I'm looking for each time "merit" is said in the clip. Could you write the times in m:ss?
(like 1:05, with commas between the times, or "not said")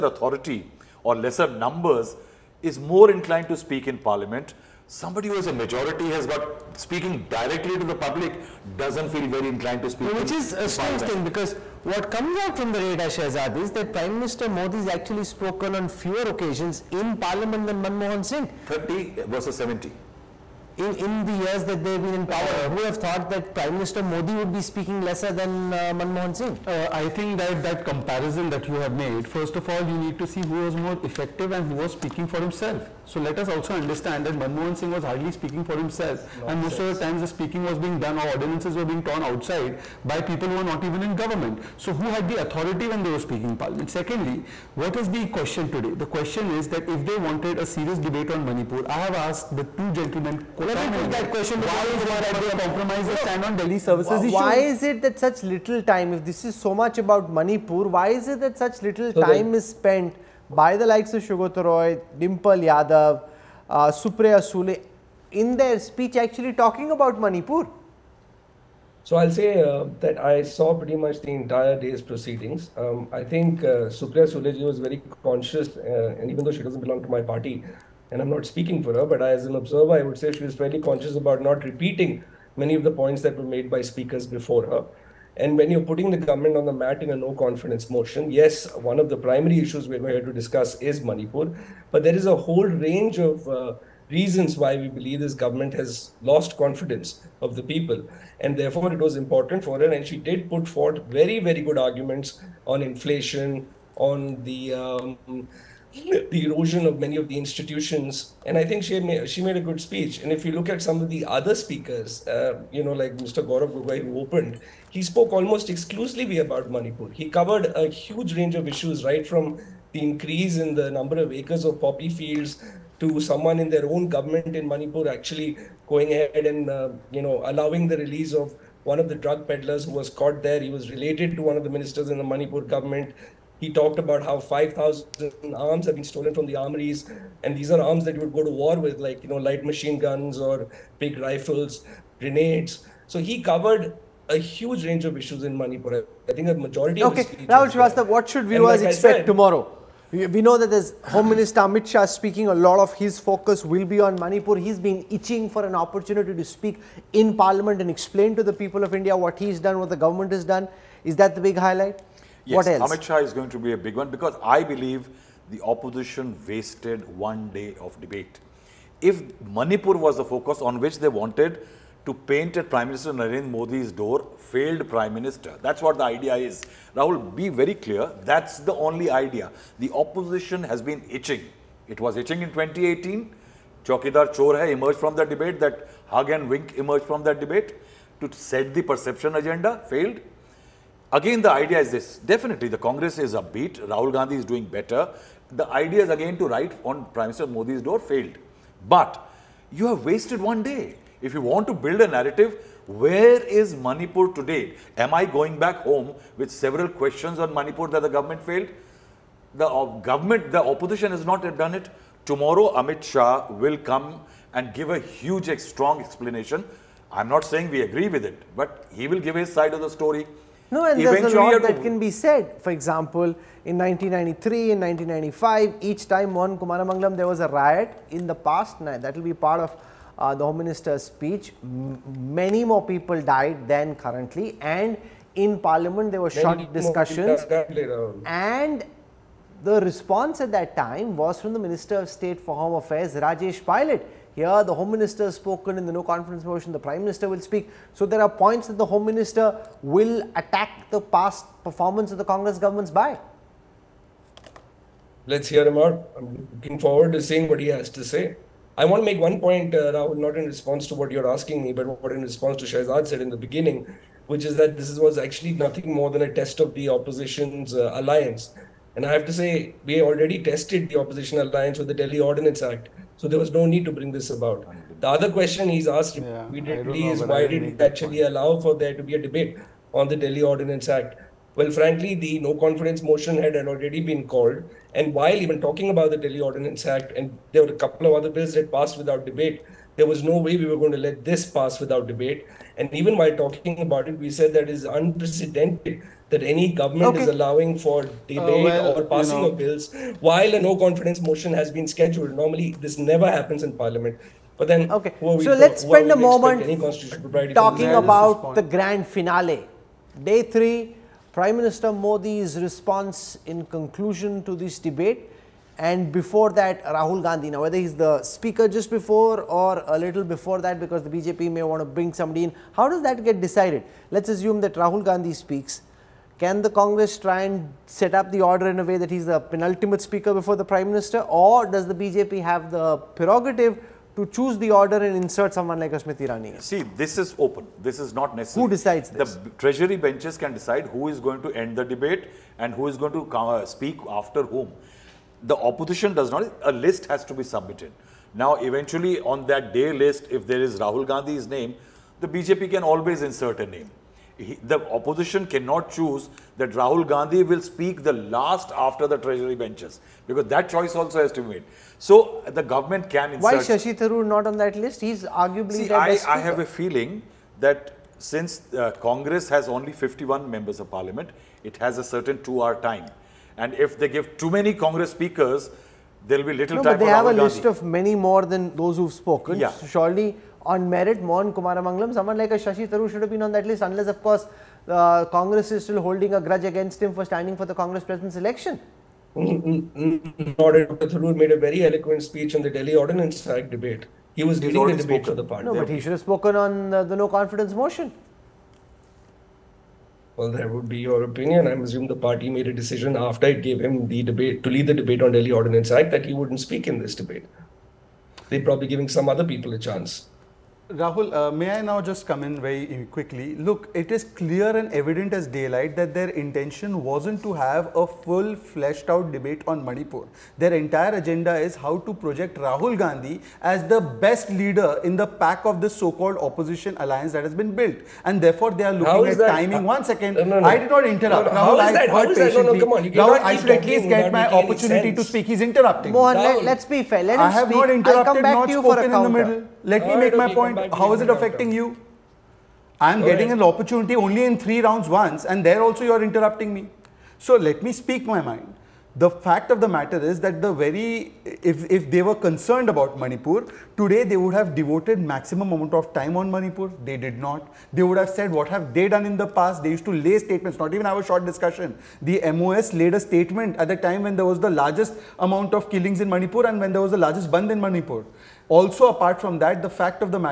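6:20.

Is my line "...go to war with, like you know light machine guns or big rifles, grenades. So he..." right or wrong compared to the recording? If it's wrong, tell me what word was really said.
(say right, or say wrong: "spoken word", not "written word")
right.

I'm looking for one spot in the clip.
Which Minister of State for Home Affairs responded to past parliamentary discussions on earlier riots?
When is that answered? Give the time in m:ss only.
4:03.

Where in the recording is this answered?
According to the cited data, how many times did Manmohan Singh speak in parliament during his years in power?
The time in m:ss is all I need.
0:19.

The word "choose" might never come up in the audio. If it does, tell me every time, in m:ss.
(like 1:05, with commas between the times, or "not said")
5:34, 5:55.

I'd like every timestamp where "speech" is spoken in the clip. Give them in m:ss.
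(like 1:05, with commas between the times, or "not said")
1:05, 1:49, 3:51, 6:32.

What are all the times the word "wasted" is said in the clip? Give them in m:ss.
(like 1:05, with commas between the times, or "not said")
2:46, 3:20.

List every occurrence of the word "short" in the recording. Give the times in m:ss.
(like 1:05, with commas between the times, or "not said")
3:56, 7:41.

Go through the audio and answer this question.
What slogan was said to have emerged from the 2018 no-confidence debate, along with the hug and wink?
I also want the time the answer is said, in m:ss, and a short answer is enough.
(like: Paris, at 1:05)
Chokidar Chor hai, at 3:03.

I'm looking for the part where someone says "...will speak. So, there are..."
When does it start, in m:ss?
4:07.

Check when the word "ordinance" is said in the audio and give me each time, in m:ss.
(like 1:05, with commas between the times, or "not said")
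0:38, 4:32, 4:40, 4:46, 6:32, 6:45.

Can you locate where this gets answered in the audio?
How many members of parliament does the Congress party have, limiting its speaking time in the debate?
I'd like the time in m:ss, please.
6:09.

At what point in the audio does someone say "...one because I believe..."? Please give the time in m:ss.
2:43.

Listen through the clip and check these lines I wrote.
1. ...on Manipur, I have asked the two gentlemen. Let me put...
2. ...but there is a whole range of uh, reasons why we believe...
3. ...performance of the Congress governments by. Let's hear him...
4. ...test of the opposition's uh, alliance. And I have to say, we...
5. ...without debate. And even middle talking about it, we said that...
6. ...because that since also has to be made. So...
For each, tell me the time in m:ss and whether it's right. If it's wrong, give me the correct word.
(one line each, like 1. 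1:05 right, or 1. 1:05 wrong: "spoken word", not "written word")
1. 0:48 right
2. 1:31 right
3. 4:11 right
4. 4:26 right
5. 4:51 wrong: "while", not "middle"
6. 6:00 wrong: "choice", not "since".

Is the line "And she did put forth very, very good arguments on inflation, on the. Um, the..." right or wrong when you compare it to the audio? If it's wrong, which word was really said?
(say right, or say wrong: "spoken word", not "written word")
right.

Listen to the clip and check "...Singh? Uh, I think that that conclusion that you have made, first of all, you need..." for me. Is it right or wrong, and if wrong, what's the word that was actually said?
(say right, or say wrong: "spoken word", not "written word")
wrong: "comparison", not "conclusion".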